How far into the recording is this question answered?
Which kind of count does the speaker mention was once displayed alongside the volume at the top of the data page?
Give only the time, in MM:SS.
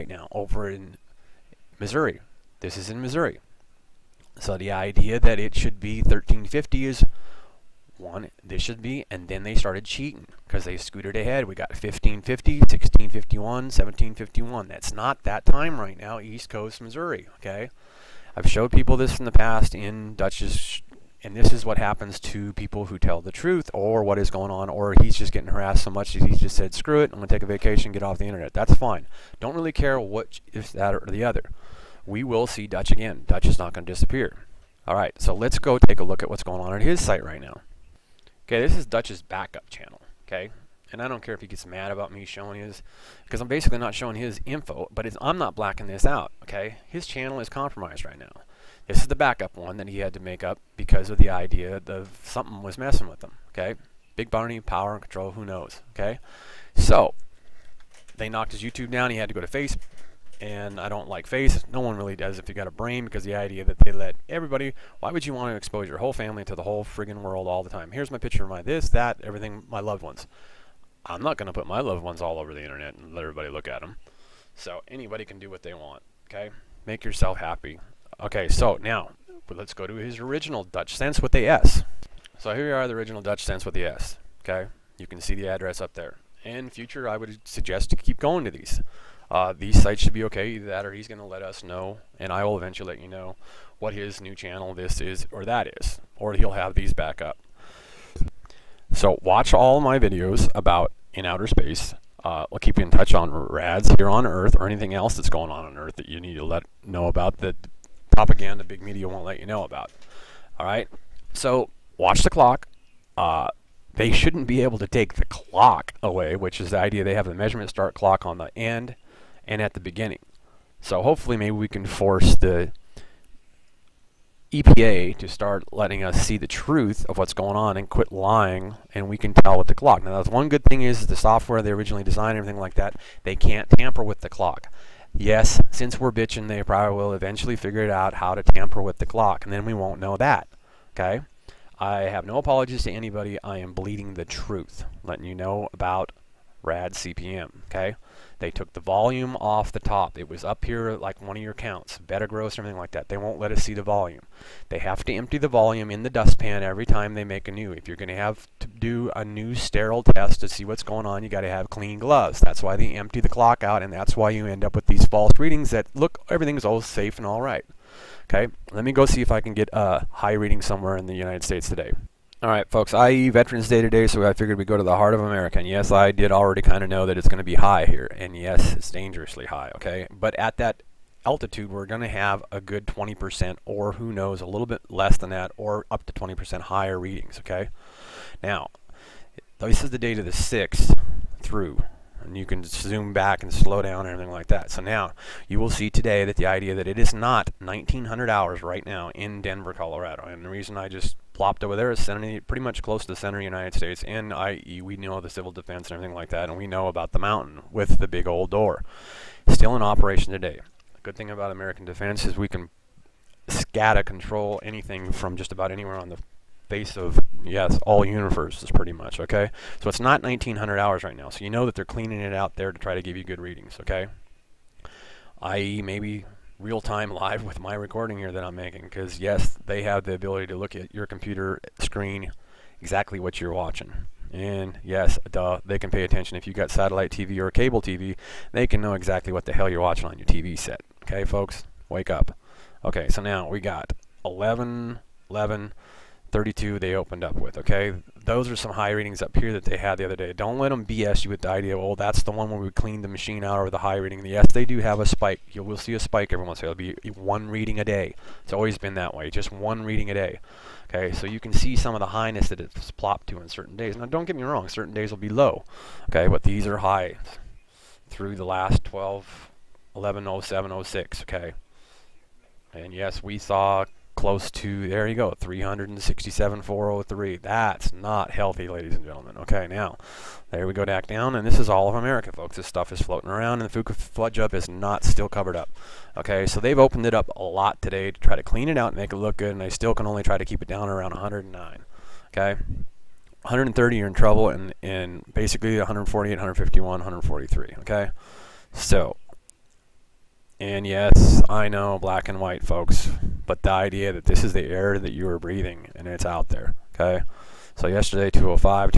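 02:31.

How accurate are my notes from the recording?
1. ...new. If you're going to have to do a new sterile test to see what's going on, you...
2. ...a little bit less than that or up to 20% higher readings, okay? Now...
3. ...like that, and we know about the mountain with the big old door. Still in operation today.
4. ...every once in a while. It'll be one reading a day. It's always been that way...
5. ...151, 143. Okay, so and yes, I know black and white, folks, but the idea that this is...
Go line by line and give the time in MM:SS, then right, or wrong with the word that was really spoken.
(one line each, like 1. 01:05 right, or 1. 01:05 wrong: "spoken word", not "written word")
1. 02:37 right
2. 03:04 right
3. 03:26 right
4. 04:16 right
5. 04:56 right.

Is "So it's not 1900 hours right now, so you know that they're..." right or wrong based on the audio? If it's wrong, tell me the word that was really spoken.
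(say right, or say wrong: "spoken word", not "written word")
right.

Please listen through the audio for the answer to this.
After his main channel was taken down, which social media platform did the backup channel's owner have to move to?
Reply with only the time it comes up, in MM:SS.
00:59.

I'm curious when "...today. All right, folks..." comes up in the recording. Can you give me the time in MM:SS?
02:51.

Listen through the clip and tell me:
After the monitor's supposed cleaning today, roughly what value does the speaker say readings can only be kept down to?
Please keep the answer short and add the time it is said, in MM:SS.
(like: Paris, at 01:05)
109, at 04:51.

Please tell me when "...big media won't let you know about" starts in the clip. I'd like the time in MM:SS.
01:48.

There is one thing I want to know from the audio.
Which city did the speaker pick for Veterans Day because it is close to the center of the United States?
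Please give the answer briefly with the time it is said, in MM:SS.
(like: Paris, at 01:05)
Denver, Colorado, at 03:19.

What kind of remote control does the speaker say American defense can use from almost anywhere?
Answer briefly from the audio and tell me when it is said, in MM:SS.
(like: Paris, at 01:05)
SCADA, at 03:33.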